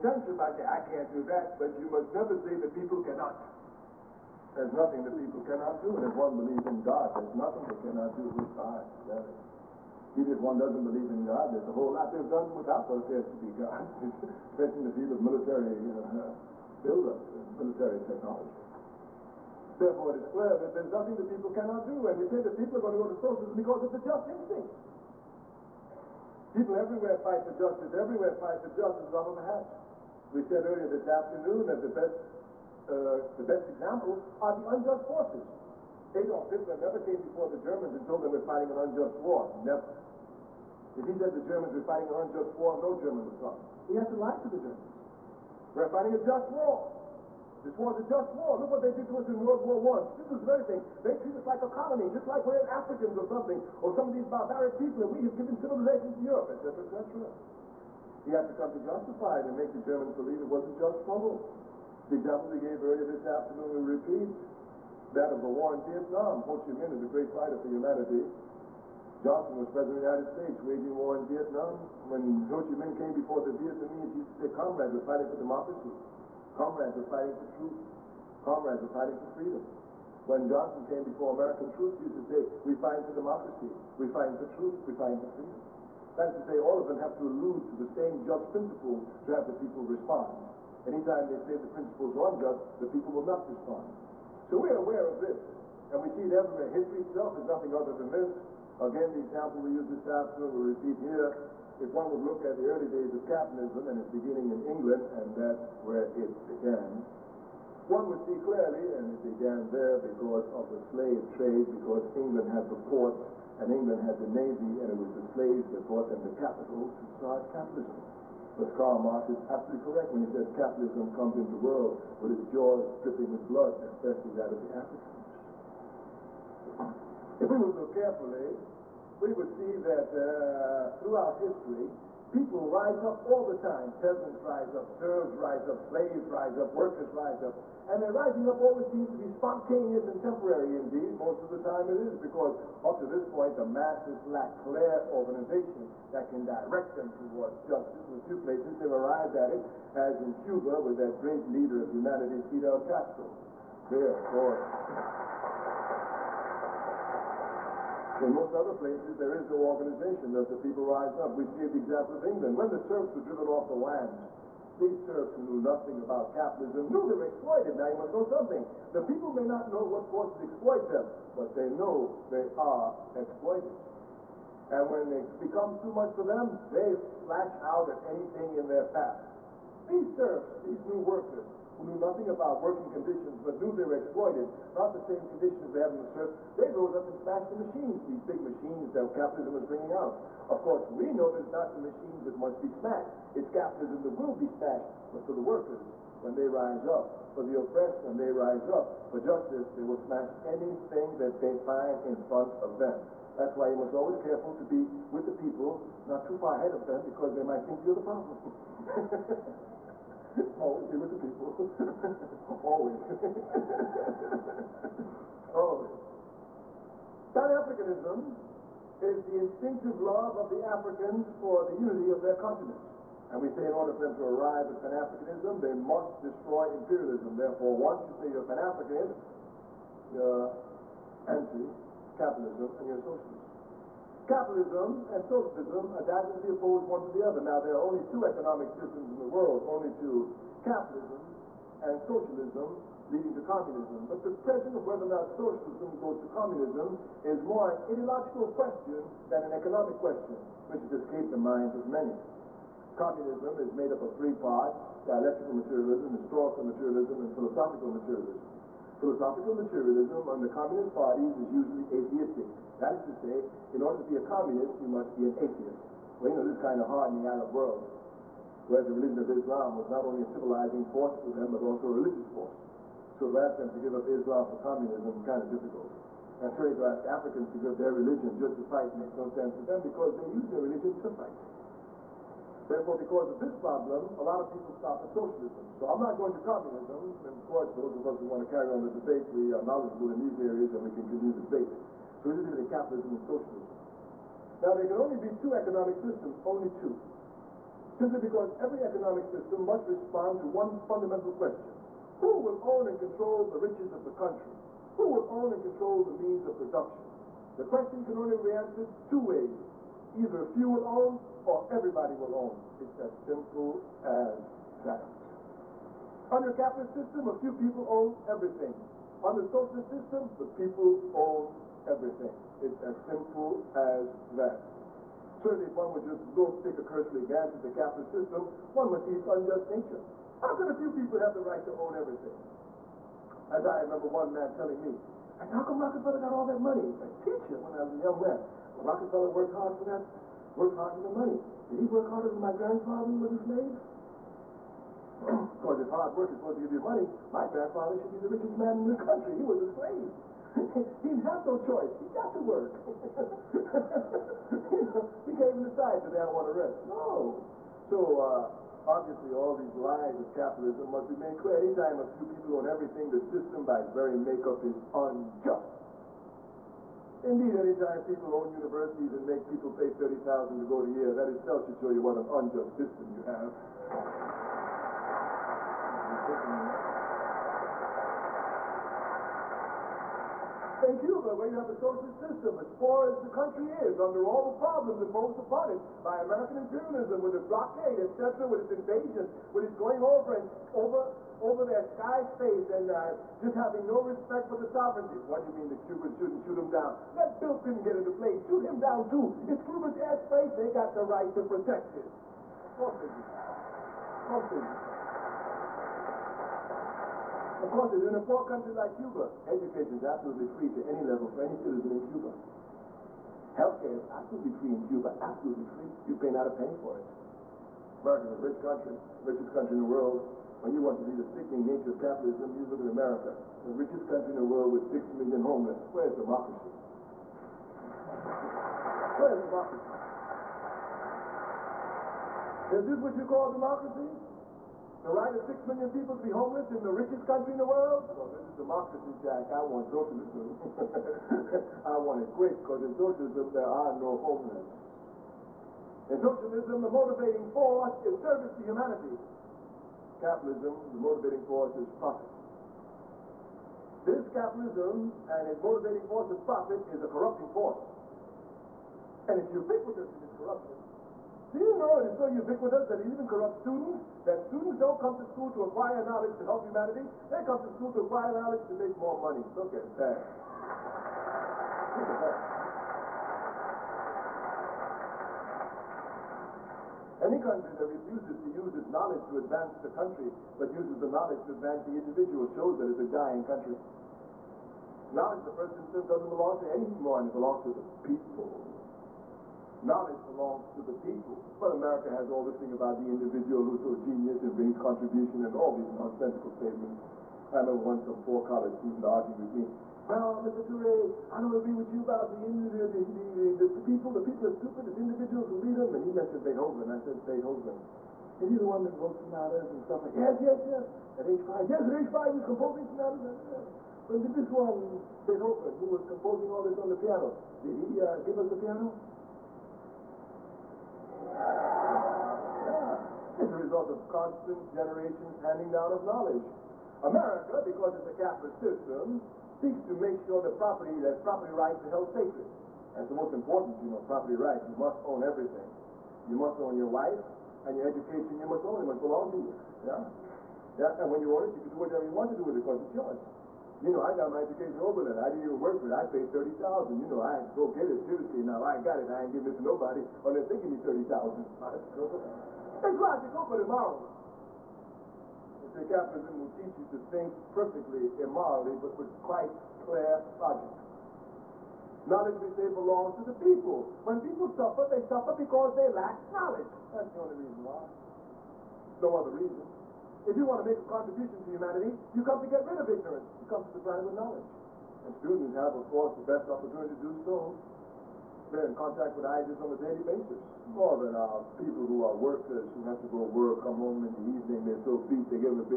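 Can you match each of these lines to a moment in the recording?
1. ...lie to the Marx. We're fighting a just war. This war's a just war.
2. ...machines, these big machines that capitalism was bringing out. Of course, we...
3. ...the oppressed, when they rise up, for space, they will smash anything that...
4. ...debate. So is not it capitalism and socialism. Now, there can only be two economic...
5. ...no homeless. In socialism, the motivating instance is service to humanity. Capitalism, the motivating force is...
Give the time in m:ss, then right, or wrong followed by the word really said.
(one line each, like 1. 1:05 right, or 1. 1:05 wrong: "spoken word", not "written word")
1. 0:44 wrong: "Germans", not "Marx"
2. 3:07 right
3. 3:17 wrong: "justice", not "space"
4. 4:51 right
5. 7:23 wrong: "force", not "instance".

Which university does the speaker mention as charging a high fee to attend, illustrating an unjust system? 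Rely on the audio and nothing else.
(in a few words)
Yale.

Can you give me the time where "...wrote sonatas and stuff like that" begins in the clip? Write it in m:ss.
8:28.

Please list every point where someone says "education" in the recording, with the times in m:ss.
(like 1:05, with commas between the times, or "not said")
6:49, 8:57, 9:04.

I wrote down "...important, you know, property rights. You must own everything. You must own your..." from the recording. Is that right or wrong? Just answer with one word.
right.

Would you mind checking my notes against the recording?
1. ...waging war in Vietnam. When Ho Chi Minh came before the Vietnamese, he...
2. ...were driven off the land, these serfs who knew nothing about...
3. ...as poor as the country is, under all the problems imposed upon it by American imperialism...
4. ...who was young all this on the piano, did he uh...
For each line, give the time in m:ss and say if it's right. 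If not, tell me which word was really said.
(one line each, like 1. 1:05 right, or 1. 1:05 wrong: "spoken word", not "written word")
1. 1:10 right
2. 2:43 right
3. 6:22 right
4. 8:35 wrong: "composing", not "young".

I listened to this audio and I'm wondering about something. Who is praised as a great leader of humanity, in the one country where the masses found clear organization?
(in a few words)
Fidel Castro.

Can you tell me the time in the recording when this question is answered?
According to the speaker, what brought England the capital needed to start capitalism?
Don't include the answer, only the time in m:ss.
1:55.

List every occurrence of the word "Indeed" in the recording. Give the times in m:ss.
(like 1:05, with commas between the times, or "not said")
2:20, 6:07.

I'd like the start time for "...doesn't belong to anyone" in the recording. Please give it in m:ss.
8:06.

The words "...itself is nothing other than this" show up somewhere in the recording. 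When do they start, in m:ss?
1:36.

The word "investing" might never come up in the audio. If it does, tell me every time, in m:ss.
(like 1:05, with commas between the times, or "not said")
not said.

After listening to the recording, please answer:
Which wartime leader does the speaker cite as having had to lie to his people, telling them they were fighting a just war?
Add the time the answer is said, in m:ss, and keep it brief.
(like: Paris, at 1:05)
Adolf Hitler, at 0:36.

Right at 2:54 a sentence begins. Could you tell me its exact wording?
And when it becomes too much for them, they slash out at anything in their path.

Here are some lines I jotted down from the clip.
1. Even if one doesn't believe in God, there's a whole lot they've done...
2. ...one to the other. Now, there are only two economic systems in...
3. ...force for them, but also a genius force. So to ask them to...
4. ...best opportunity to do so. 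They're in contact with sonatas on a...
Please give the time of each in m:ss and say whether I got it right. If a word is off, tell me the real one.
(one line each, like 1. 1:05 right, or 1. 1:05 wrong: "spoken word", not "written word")
1. 0:10 right
2. 3:56 right
3. 4:30 wrong: "religious", not "genius"
4. 9:36 wrong: "ideas", not "sonatas".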